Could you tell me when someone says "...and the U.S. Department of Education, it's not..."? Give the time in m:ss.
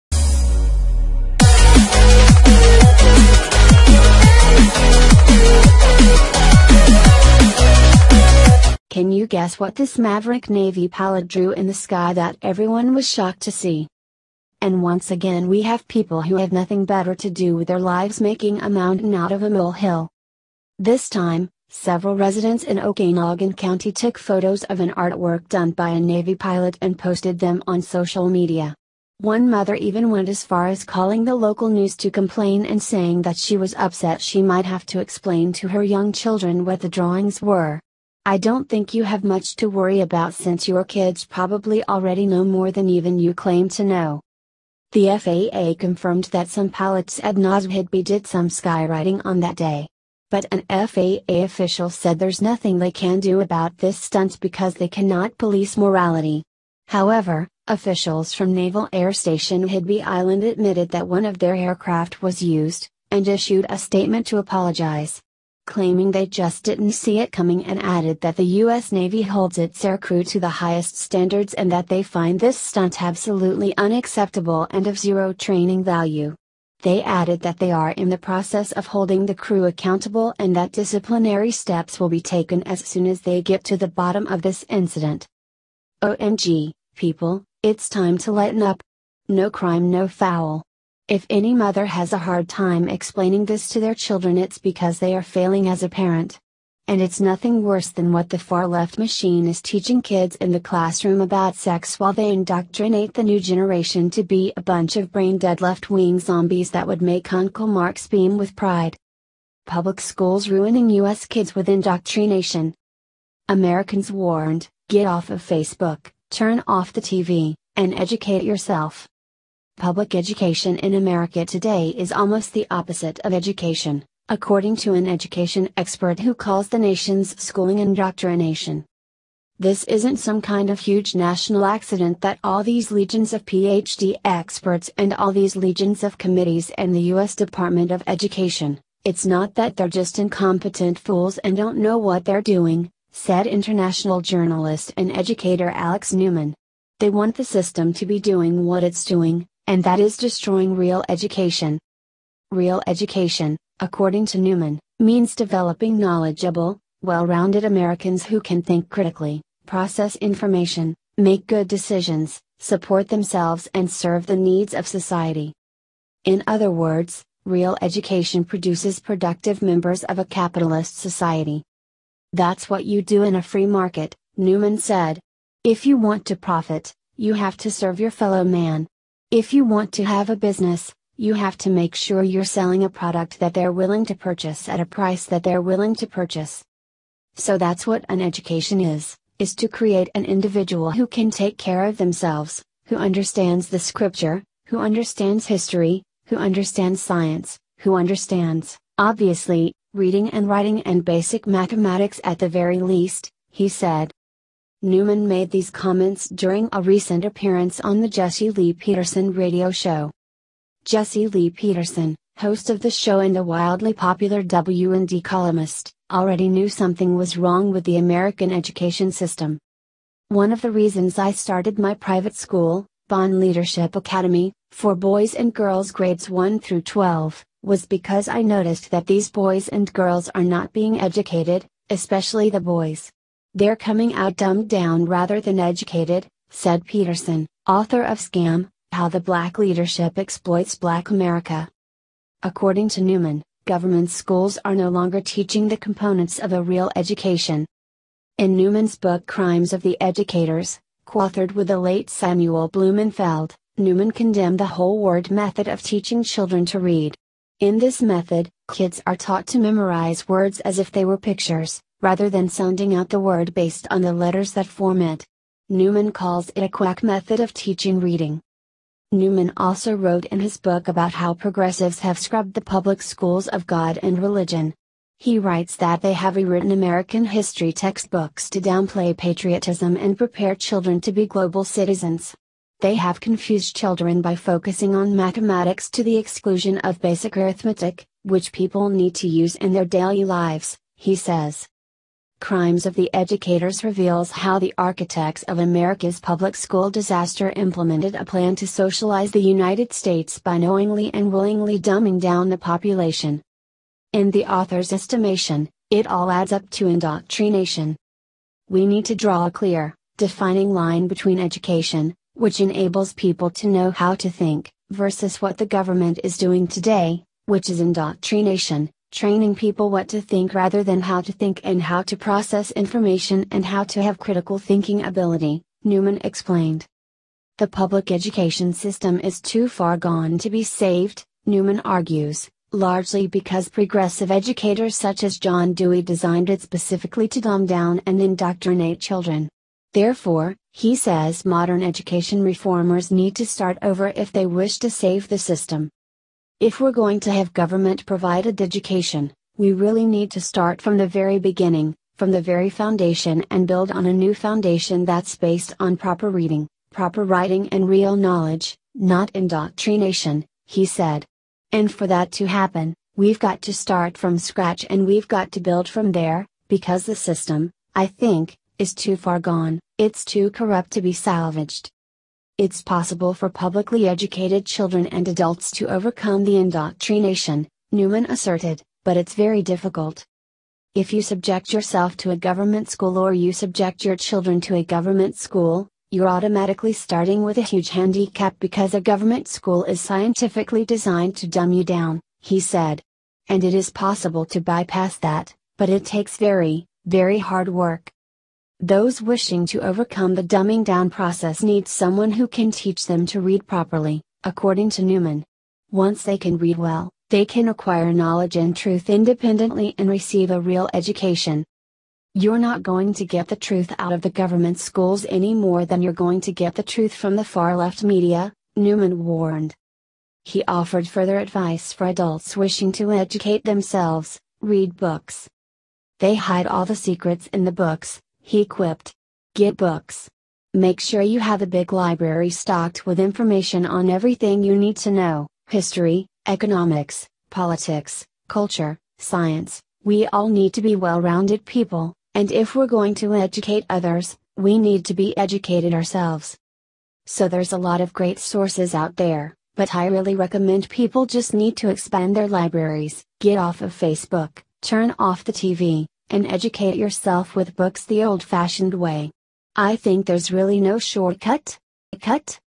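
2:16.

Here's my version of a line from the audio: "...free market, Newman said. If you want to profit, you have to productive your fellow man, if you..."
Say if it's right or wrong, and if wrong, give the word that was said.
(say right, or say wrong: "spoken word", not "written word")
wrong: "serve", not "productive".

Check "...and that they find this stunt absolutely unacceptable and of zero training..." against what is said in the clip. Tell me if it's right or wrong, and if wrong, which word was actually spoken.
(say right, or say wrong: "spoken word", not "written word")
right.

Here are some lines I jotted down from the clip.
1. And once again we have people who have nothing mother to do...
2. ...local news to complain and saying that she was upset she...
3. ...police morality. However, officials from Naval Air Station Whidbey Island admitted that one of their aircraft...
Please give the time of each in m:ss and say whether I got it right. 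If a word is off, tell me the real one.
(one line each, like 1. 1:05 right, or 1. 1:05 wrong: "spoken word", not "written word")
1. 0:14 wrong: "better", not "mother"
2. 0:31 right
3. 0:55 right.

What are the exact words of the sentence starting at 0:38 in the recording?
I don't think you have much to worry about since your kids probably already know more than even you claim to know.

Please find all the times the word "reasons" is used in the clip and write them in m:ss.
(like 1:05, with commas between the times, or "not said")
3:40.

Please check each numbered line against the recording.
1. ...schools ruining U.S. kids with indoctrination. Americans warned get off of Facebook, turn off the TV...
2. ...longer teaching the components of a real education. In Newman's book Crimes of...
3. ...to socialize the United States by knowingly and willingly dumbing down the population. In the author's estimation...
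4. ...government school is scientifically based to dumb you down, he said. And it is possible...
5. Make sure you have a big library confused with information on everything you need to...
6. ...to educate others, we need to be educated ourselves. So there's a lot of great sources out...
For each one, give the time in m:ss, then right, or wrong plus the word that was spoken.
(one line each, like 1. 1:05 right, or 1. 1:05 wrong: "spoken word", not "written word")
1. 1:49 right
2. 4:04 right
3. 4:58 right
4. 6:29 wrong: "designed", not "based"
5. 7:10 wrong: "stocked", not "confused"
6. 7:23 right.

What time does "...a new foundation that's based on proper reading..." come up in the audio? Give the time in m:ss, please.
5:54.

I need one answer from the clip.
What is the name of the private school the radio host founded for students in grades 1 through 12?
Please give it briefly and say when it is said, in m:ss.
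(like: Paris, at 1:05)
Bond Leadership Academy, at 3:43.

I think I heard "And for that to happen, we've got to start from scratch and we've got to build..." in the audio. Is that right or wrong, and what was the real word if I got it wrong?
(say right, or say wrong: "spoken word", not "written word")
right.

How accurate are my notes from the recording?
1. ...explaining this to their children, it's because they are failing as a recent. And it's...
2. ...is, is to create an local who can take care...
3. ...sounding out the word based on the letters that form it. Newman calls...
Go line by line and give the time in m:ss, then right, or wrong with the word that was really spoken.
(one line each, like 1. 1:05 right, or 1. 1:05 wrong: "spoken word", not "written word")
1. 1:32 wrong: "parent", not "recent"
2. 3:08 wrong: "individual", not "local"
3. 4:22 right.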